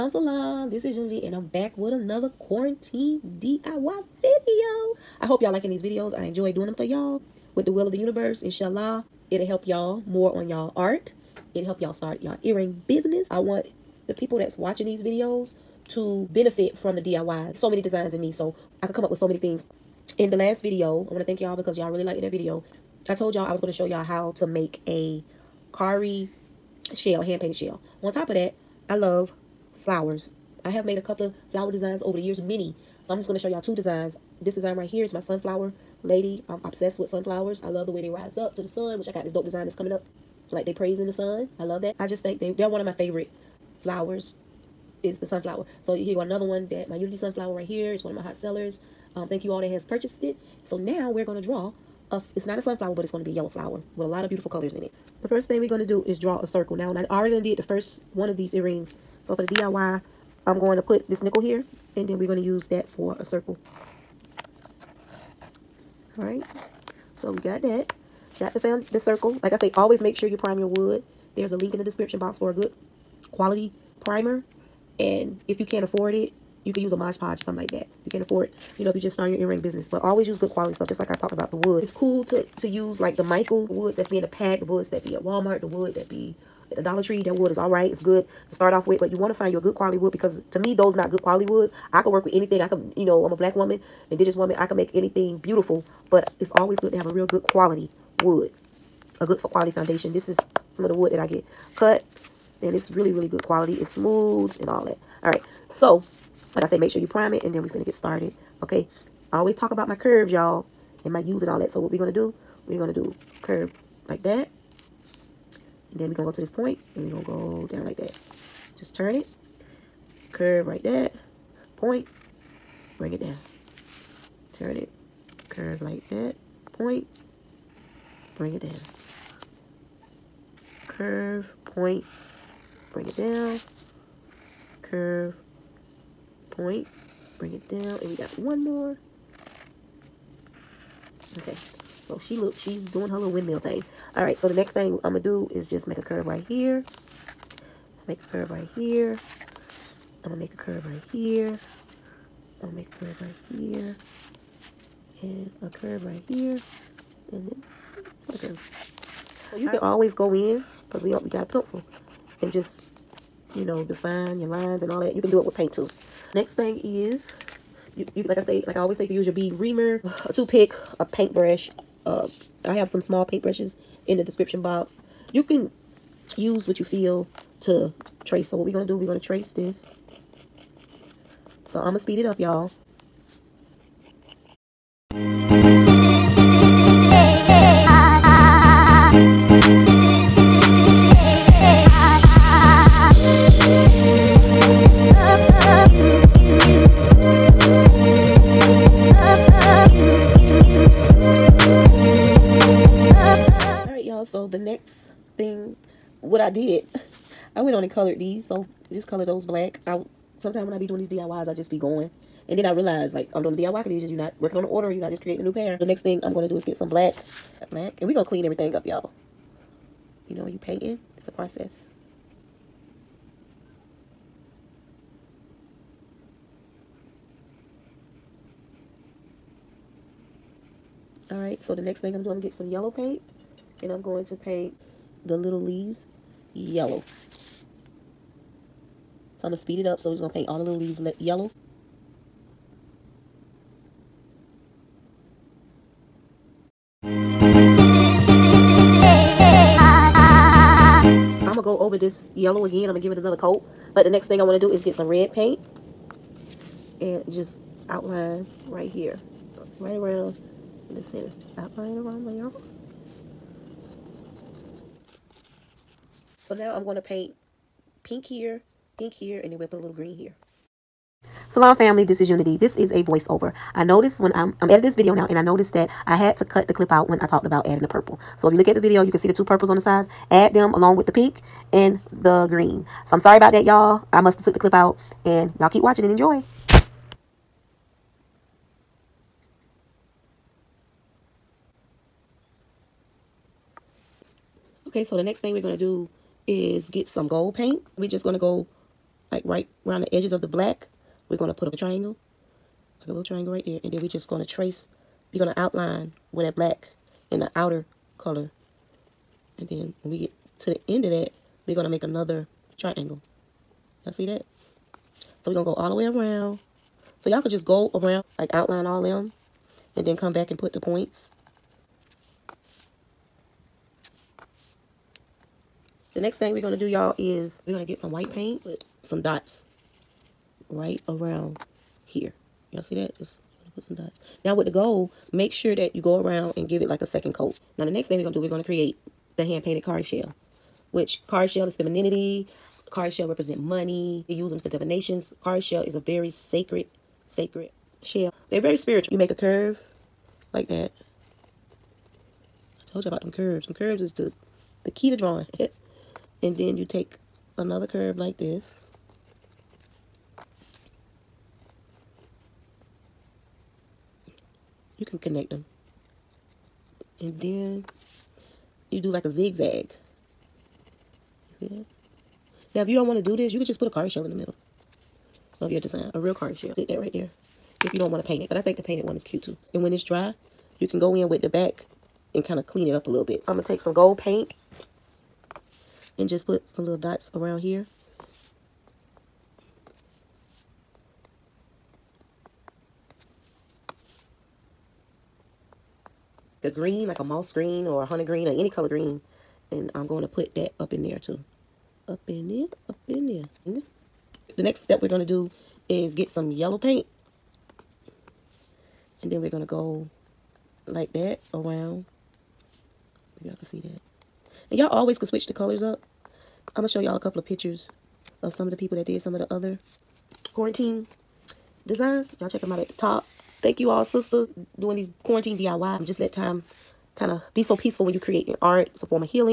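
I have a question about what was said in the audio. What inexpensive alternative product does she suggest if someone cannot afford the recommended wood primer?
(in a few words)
Mod Podge.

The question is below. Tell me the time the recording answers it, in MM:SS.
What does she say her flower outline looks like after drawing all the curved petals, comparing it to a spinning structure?
02:23.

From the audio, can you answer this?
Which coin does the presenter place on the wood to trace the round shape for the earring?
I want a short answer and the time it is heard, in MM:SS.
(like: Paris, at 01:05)
nickel, at 01:01.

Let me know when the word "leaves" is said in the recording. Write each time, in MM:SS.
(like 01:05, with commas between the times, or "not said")
03:55, 04:00.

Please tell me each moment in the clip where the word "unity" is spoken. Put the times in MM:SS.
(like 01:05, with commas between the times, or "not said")
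00:00, 00:46, 04:32.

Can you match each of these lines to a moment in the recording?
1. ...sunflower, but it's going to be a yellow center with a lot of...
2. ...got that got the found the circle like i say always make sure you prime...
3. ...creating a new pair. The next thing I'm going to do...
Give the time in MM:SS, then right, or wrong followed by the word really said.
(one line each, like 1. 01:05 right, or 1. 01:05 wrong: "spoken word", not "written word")
1. 00:52 wrong: "flower", not "center"
2. 01:07 right
3. 03:35 right.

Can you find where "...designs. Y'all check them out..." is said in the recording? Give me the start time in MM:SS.
07:01.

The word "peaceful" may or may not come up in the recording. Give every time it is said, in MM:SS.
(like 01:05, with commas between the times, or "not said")
07:07.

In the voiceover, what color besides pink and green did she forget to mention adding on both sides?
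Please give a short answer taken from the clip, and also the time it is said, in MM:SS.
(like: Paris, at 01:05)
purple, at 04:37.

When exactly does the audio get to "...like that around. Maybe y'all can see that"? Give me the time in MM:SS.
06:50.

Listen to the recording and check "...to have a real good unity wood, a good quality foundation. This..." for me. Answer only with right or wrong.
wrong.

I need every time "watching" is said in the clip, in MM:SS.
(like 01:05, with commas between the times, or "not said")
00:14, 04:45.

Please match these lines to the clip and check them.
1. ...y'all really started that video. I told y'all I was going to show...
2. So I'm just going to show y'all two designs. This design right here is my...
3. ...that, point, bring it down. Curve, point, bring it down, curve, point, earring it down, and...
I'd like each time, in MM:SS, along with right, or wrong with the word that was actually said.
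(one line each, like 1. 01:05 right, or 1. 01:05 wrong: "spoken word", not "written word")
1. 00:21 wrong: "liked", not "started"
2. 00:33 right
3. 02:06 wrong: "bring", not "earring".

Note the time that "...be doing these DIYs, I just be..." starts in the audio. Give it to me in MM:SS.
03:30.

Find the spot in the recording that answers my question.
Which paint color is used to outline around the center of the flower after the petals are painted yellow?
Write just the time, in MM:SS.
04:15.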